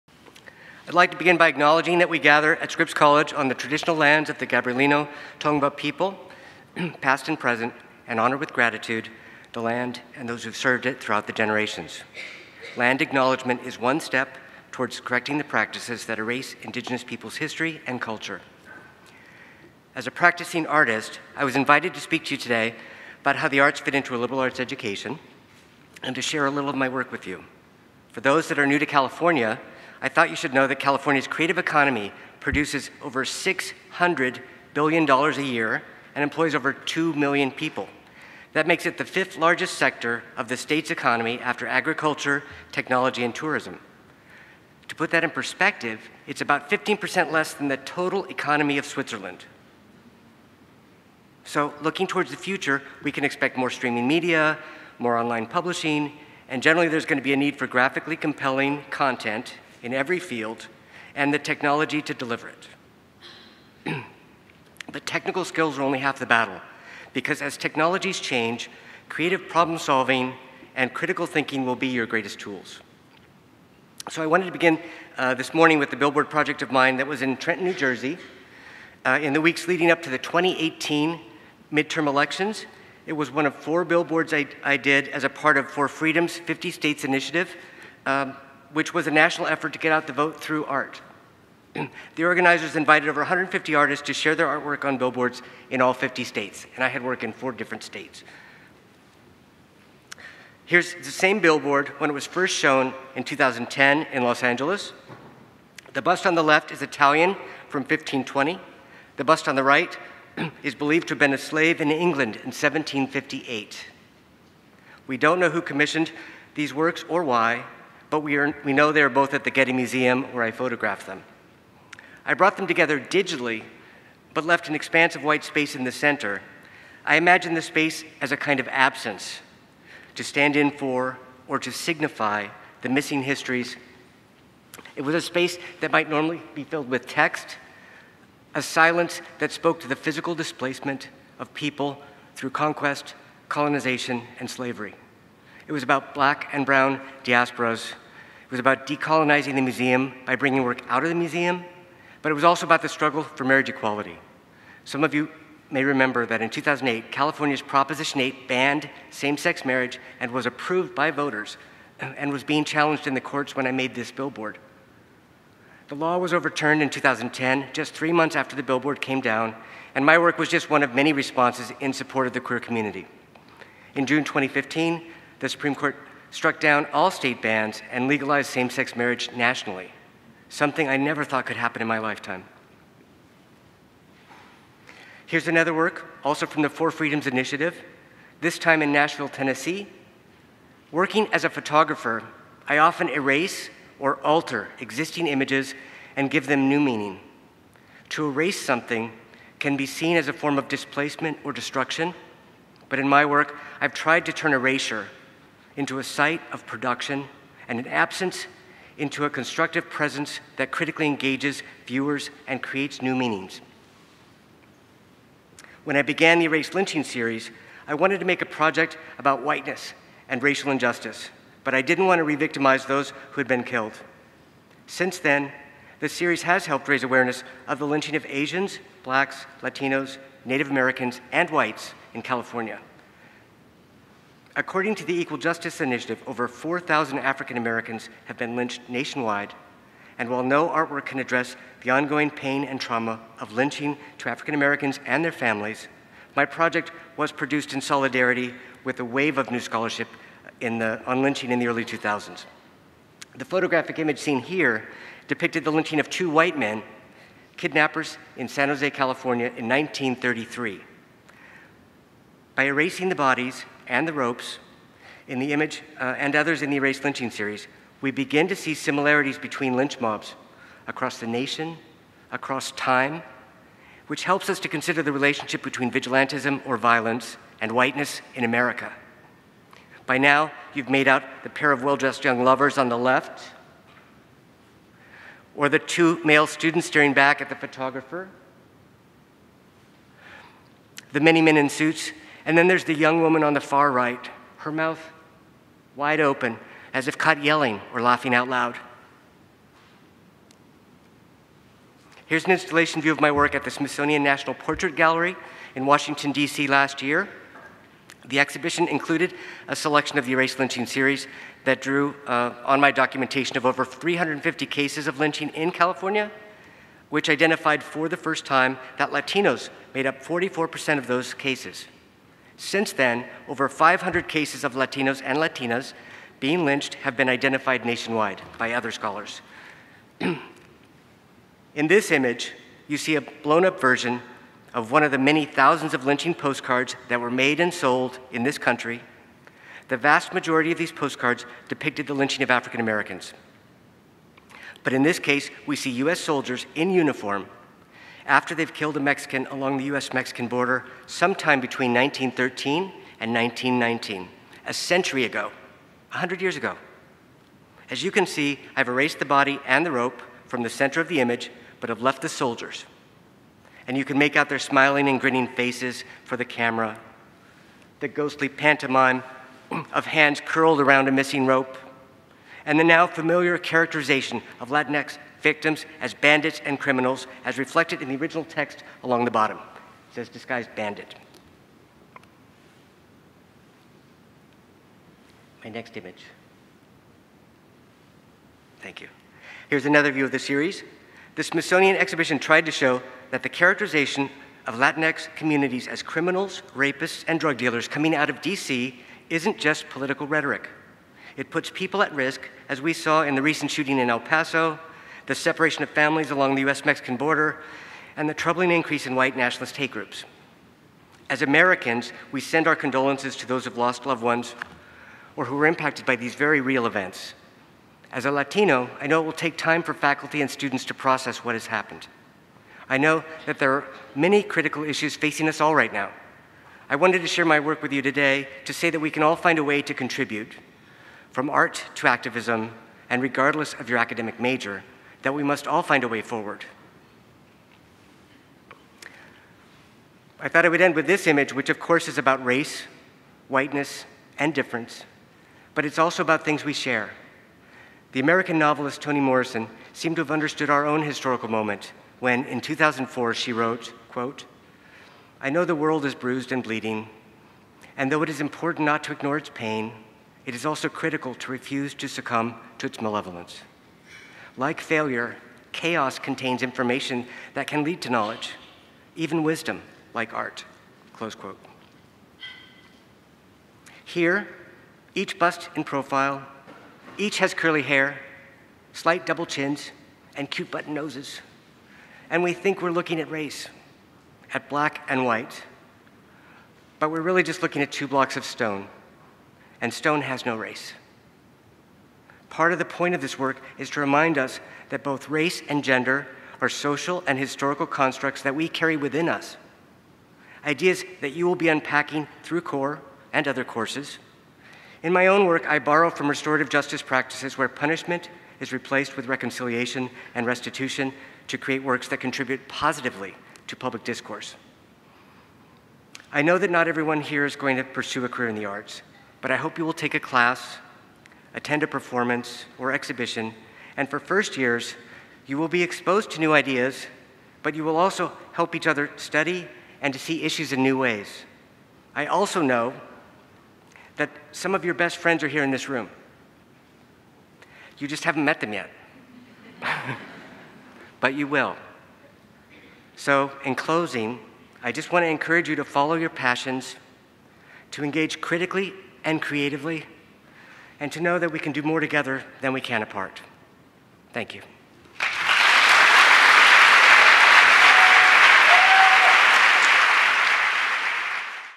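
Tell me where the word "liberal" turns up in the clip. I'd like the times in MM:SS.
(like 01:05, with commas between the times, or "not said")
00:24.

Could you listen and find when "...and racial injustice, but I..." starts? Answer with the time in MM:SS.
03:40.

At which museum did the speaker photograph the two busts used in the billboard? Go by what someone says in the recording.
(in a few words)
Getty Museum.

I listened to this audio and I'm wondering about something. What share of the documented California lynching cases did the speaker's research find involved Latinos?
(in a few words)
44%.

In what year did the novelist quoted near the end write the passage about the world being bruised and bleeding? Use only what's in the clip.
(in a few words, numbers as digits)
2004.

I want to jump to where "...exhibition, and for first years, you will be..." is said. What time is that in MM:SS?
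08:42.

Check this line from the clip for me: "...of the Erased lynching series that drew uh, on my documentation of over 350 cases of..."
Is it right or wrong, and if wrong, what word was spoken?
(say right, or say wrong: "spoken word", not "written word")
right.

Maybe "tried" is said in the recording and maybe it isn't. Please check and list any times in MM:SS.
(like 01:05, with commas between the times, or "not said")
03:23, 06:32.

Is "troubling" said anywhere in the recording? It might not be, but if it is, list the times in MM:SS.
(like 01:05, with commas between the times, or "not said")
06:48.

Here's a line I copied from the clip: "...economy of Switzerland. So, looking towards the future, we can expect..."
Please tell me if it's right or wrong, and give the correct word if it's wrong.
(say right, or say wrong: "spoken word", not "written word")
right.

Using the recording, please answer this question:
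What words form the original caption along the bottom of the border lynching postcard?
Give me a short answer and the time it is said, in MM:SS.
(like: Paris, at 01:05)
Disguised bandit, at 06:20.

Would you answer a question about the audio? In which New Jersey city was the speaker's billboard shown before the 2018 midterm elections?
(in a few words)
Trenton.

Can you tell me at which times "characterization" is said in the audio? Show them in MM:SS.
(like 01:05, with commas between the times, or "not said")
06:13, 06:33.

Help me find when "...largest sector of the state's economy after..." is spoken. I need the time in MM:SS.
00:39.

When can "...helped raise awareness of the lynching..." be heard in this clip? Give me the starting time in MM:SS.
03:46.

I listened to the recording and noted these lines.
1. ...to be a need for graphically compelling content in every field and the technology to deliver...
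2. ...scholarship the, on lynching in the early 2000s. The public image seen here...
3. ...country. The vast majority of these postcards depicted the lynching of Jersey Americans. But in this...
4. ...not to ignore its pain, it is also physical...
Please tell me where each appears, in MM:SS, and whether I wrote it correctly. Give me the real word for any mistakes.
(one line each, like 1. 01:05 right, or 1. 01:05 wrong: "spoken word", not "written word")
1. 00:57 right
2. 04:09 wrong: "photographic", not "public"
3. 05:38 wrong: "African", not "Jersey"
4. 07:38 wrong: "critical", not "physical".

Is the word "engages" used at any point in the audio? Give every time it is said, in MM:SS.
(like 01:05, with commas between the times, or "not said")
03:31, 09:08.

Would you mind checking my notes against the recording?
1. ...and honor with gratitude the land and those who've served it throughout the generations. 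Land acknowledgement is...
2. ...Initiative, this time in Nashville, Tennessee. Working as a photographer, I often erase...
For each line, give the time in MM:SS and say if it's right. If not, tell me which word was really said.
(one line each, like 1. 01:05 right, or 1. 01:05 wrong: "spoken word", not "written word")
1. 00:08 right
2. 03:07 right.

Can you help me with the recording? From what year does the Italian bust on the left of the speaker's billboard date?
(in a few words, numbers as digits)
1520.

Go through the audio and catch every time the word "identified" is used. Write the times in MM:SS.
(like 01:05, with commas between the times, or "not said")
05:17, 05:27.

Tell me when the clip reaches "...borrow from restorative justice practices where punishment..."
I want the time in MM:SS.
08:25.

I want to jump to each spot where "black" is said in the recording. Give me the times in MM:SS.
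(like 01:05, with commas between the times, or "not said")
02:26, 03:49, 08:04.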